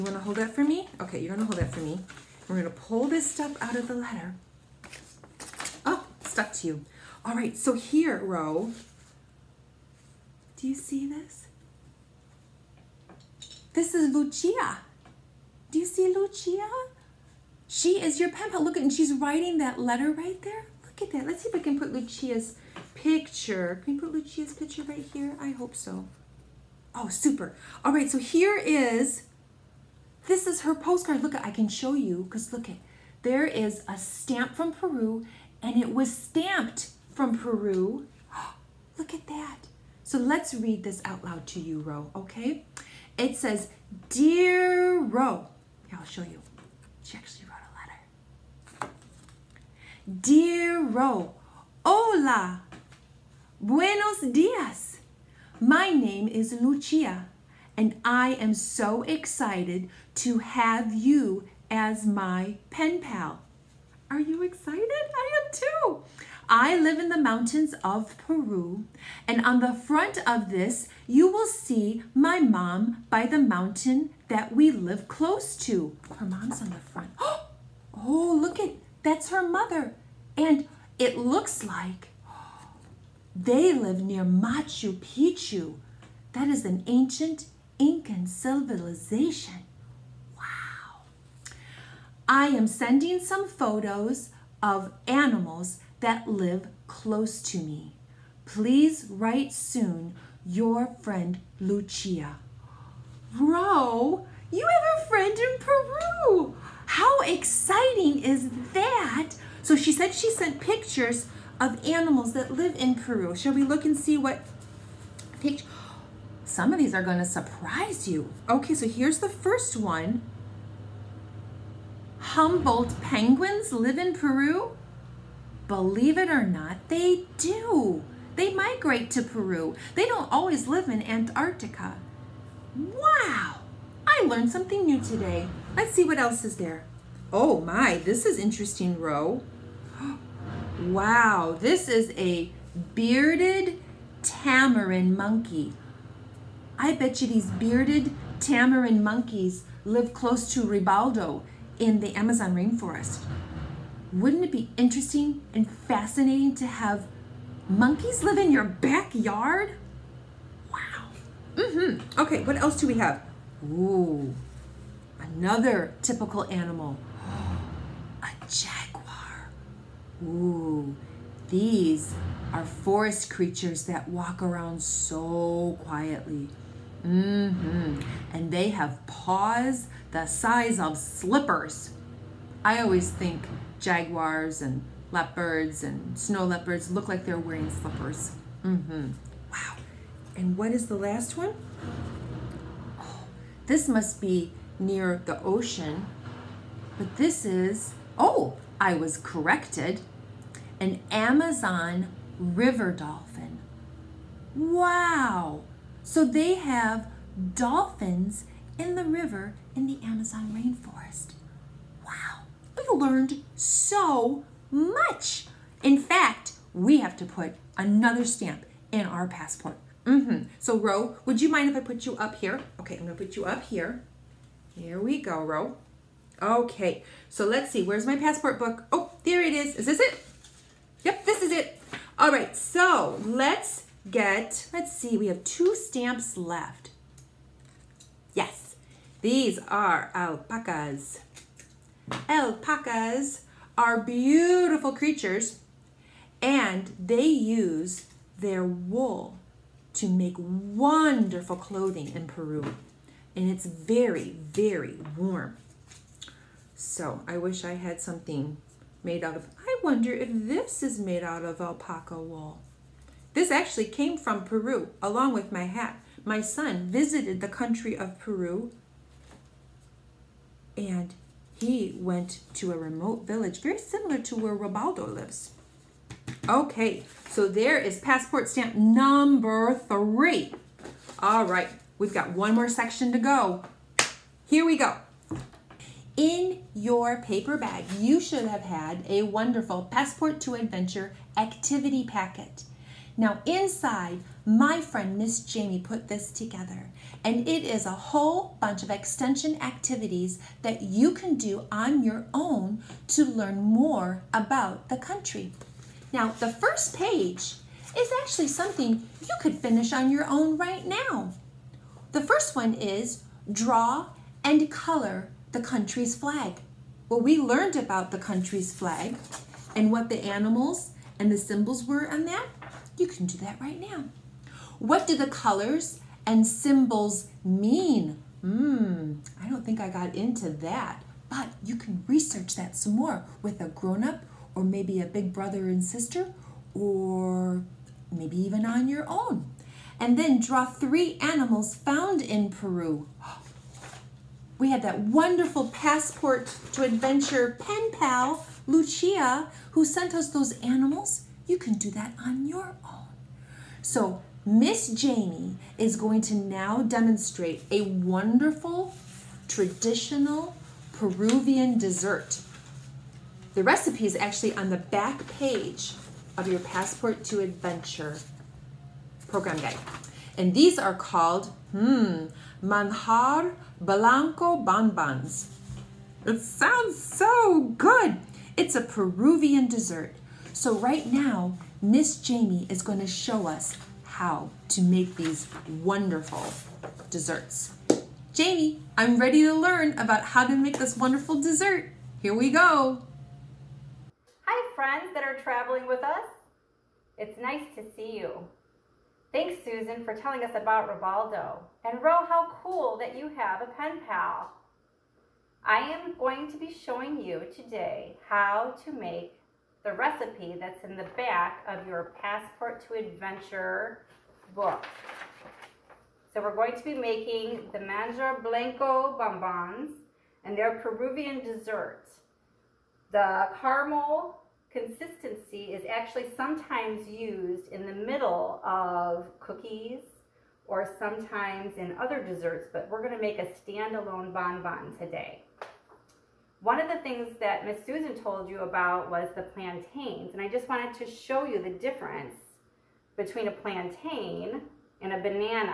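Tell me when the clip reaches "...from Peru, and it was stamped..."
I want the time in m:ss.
0:34.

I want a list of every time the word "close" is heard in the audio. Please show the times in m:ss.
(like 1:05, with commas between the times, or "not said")
1:15, 1:36, 2:30.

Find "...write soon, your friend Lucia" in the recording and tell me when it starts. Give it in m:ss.
1:39.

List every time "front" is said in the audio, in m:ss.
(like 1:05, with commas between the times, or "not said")
1:09, 1:16.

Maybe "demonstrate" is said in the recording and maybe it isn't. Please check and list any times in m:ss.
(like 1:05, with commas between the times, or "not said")
5:56.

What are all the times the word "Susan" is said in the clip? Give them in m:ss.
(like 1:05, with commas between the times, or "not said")
6:39, 7:17.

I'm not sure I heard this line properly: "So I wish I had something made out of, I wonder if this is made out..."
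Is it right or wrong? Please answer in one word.
right.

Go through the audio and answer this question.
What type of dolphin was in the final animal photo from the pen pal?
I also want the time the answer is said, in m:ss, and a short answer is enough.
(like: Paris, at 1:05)
Amazon river dolphin, at 3:20.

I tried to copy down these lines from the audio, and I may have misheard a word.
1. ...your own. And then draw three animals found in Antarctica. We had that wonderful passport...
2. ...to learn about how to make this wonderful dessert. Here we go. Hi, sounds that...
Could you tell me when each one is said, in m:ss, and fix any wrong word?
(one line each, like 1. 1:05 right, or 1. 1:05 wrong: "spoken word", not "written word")
1. 5:38 wrong: "Peru", not "Antarctica"
2. 6:29 wrong: "friends", not "sounds".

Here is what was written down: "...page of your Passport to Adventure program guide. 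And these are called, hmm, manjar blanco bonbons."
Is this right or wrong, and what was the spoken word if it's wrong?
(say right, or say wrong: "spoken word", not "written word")
right.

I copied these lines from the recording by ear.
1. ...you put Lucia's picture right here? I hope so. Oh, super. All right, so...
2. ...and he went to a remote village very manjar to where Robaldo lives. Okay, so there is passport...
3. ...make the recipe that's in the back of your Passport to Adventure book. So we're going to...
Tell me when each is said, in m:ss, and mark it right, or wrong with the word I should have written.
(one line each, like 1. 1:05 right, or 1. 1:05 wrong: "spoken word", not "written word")
1. 0:23 right
2. 4:30 wrong: "similar", not "manjar"
3. 6:48 right.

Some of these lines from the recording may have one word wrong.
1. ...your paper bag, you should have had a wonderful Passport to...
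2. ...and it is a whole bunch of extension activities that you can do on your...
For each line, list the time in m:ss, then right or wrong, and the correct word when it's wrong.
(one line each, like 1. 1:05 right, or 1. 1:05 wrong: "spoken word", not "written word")
1. 4:46 right
2. 4:57 right.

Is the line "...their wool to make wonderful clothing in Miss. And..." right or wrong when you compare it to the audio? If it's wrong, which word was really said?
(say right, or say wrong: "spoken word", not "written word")
wrong: "Peru", not "Miss".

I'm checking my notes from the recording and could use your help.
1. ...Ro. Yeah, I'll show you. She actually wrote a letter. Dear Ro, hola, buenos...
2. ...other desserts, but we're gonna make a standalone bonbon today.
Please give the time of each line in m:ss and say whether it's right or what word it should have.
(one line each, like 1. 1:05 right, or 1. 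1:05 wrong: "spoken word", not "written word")
1. 0:45 right
2. 7:12 right.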